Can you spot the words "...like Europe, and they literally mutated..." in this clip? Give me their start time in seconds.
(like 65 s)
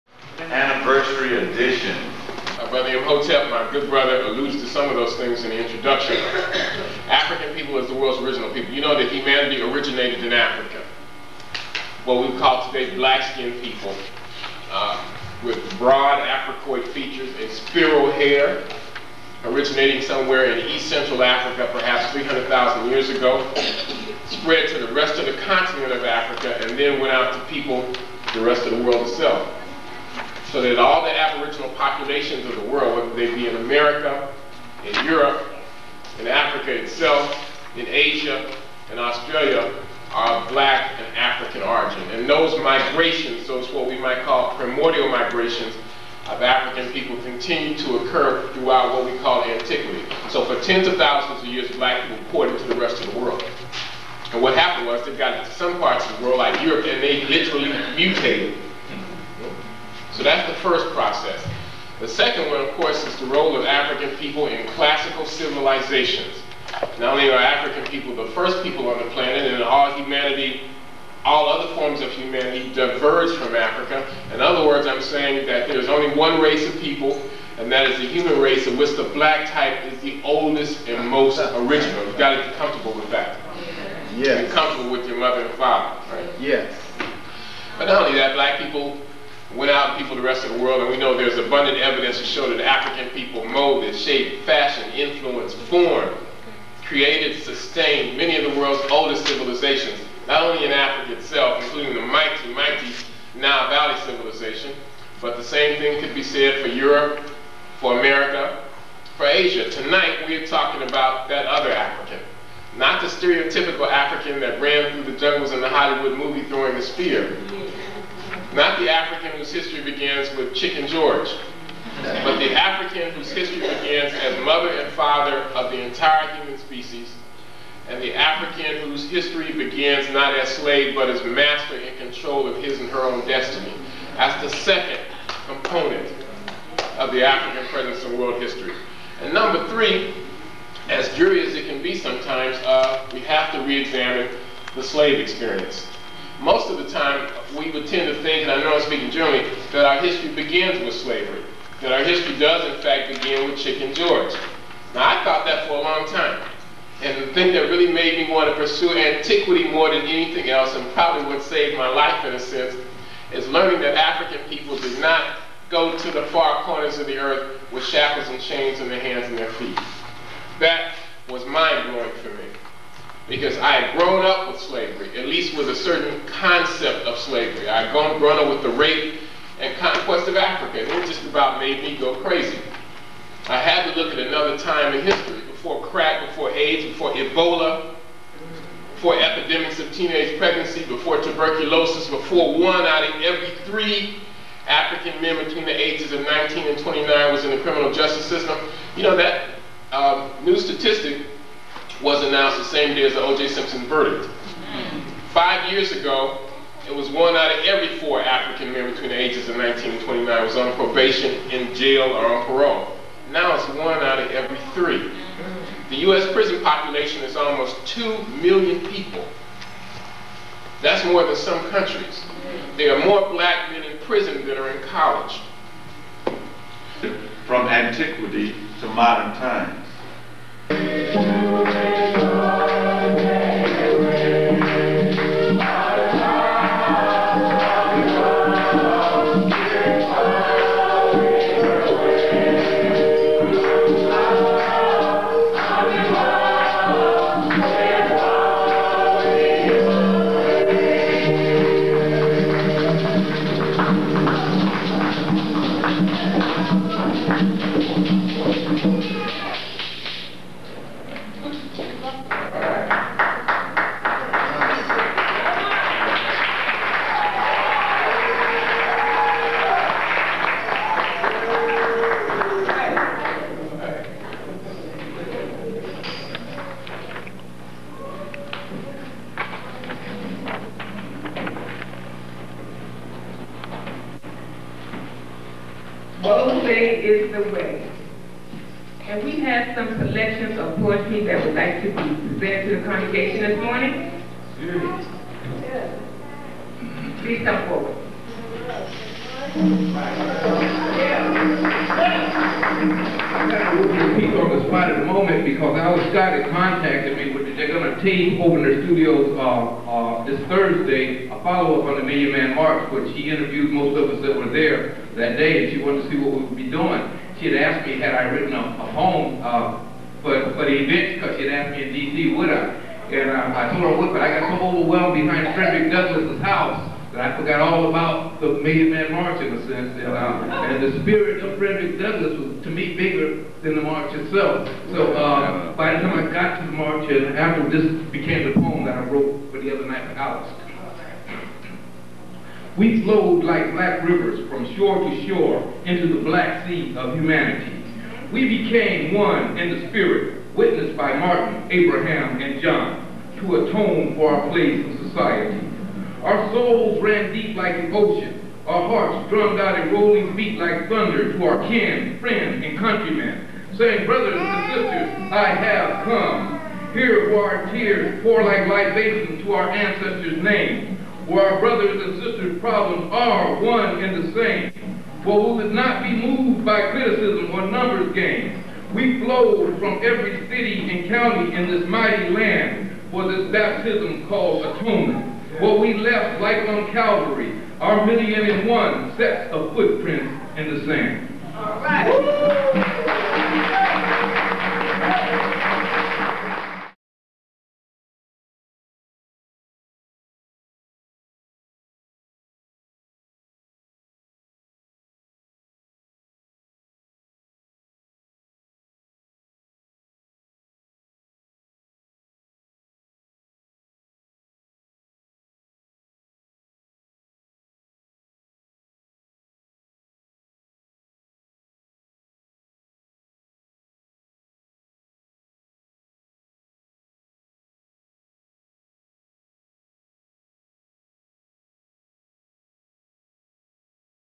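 56 s.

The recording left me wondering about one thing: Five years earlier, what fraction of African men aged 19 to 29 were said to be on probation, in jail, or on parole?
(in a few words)
One out of every four.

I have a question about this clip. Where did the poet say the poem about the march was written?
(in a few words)
Dallas.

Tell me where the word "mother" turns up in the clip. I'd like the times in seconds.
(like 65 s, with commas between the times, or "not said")
85 s, 124 s.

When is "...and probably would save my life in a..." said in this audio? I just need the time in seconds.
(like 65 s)
160 s.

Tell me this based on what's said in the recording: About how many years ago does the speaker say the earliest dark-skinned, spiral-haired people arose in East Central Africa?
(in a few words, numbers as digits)
300,000.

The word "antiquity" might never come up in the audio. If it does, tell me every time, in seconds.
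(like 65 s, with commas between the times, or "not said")
49 s, 158 s, 227 s.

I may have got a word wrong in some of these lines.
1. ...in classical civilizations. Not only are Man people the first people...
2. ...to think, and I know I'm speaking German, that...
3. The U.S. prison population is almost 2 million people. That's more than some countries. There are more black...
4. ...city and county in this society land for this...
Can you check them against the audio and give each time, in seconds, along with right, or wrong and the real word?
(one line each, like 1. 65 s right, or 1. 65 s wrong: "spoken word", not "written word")
1. 64 s wrong: "African", not "Man"
2. 148 s right
3. 215 s right
4. 380 s wrong: "mighty", not "society".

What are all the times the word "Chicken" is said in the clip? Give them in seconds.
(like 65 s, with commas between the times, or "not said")
120 s, 153 s.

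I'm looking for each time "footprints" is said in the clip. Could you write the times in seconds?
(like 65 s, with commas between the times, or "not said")
389 s.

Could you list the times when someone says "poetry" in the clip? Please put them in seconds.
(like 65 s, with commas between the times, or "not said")
290 s.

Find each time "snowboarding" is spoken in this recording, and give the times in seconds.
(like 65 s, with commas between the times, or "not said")
not said.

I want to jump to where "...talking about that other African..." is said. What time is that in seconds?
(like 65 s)
110 s.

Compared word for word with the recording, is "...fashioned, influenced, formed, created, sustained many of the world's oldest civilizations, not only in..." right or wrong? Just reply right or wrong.
right.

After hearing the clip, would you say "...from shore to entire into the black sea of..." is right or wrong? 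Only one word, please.
wrong.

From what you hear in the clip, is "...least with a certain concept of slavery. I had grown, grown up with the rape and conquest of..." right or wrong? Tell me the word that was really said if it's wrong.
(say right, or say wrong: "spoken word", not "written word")
right.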